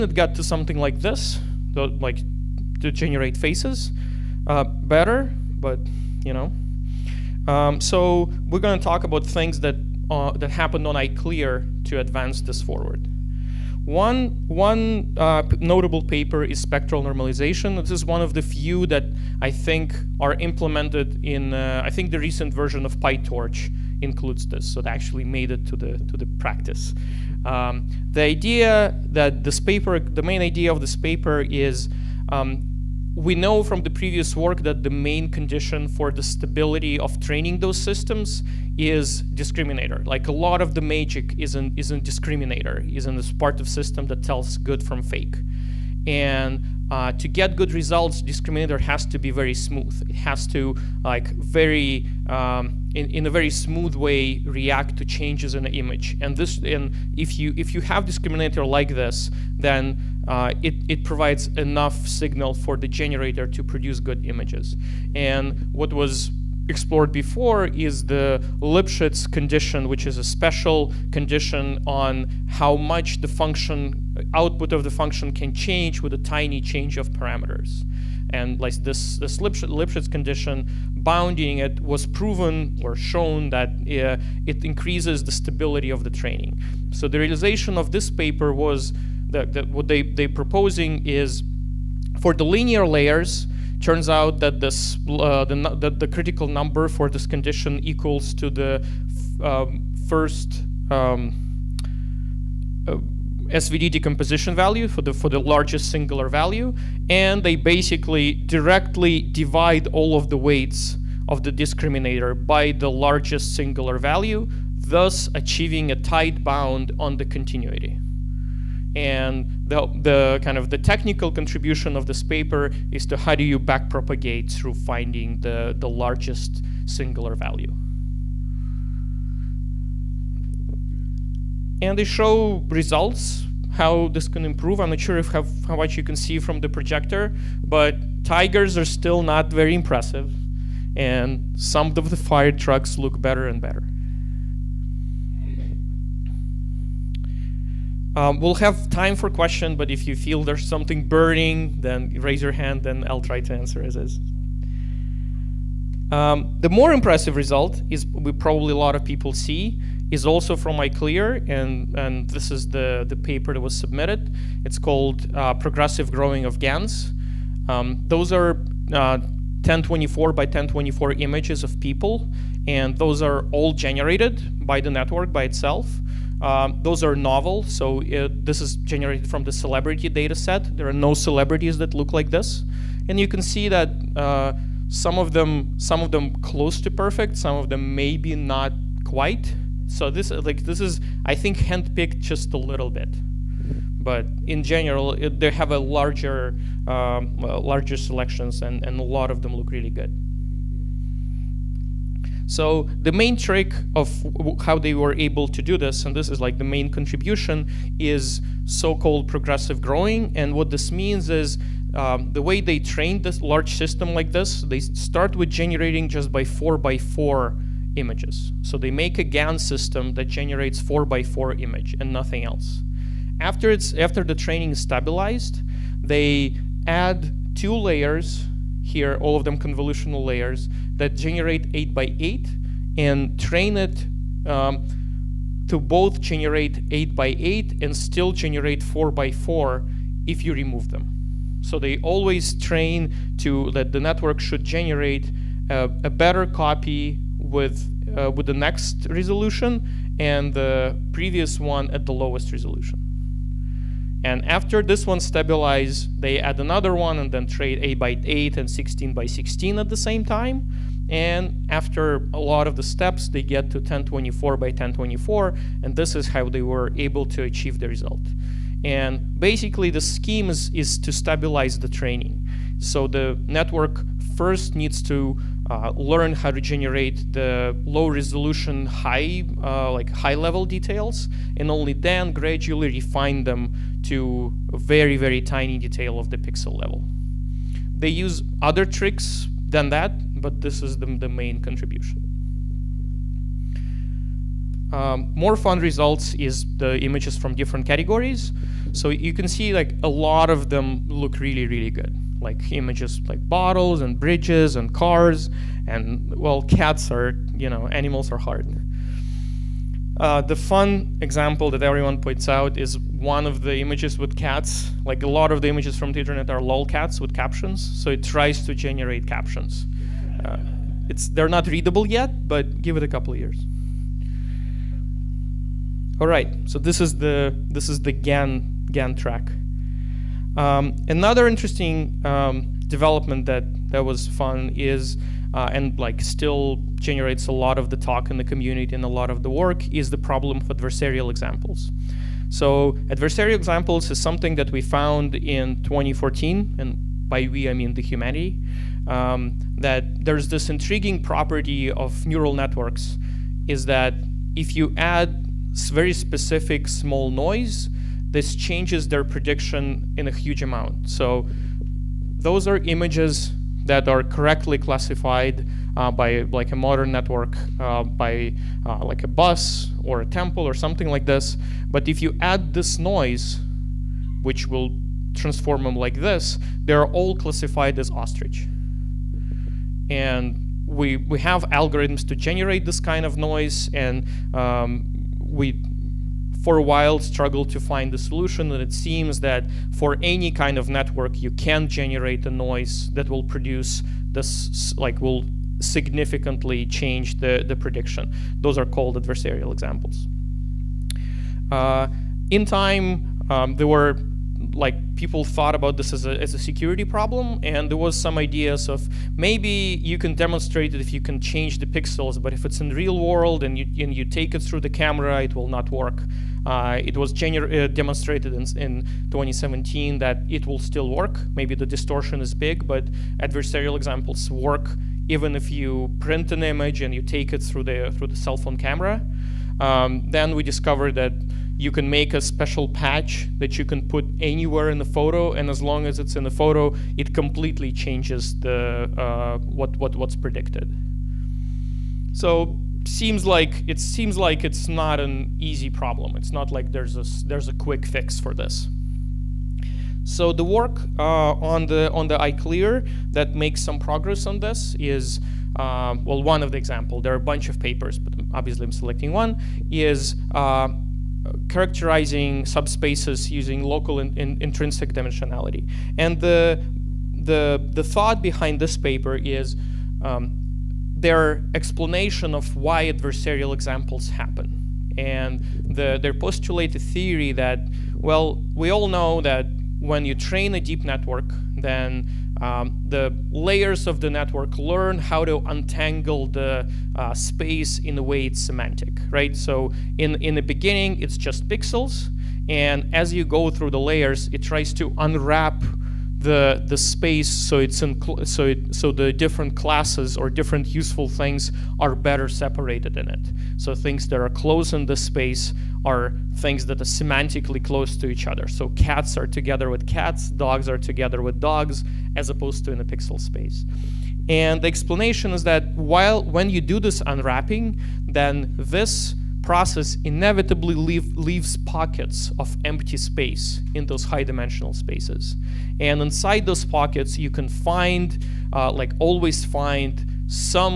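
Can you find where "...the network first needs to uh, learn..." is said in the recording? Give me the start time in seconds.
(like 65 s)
273 s.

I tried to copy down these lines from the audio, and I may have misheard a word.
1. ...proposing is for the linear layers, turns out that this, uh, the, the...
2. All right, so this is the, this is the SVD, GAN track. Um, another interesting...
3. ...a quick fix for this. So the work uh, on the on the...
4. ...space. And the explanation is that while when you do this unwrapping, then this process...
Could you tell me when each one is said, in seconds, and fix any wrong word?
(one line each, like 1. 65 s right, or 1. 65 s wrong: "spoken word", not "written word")
1. 90 s right
2. 326 s wrong: "GAN", not "SVD"
3. 447 s right
4. 513 s right.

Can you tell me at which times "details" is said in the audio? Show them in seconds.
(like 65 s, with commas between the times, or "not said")
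280 s, 285 s.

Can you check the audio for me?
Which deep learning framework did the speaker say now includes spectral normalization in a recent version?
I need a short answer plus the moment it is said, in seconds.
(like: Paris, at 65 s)
PyTorch, at 22 s.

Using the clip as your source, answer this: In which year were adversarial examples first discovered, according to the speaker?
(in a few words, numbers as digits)
2014.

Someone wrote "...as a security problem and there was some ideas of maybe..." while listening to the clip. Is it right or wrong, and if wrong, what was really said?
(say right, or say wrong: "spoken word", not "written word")
right.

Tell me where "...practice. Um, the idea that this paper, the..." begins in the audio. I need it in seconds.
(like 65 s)
26 s.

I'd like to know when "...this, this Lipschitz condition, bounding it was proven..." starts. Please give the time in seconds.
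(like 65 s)
78 s.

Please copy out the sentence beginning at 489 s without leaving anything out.
So in, in the beginning, it's just pixels.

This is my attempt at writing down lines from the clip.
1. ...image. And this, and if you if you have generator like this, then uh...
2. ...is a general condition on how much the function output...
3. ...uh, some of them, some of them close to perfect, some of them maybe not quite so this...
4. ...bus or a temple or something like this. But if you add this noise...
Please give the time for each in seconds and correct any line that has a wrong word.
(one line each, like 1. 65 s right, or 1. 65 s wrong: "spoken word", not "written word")
1. 55 s wrong: "discriminator", not "generator"
2. 70 s wrong: "special", not "general"
3. 184 s right
4. 369 s right.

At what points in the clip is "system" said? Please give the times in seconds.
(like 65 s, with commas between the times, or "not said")
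37 s, 43 s, 213 s, 219 s.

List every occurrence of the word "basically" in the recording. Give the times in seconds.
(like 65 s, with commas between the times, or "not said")
107 s, 269 s.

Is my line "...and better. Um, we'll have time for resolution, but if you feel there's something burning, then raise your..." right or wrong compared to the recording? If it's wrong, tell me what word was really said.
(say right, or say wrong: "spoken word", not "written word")
wrong: "question", not "resolution".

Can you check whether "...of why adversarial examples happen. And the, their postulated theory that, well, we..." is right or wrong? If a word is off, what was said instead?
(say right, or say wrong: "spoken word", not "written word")
right.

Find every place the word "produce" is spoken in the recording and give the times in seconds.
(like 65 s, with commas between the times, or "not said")
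63 s, 393 s.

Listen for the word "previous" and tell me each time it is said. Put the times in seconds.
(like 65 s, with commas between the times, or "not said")
33 s, 251 s.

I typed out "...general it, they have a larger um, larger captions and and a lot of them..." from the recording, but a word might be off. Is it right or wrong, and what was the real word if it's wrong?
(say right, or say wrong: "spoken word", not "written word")
wrong: "selections", not "captions".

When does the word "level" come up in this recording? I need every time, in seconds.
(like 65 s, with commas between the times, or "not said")
280 s, 286 s.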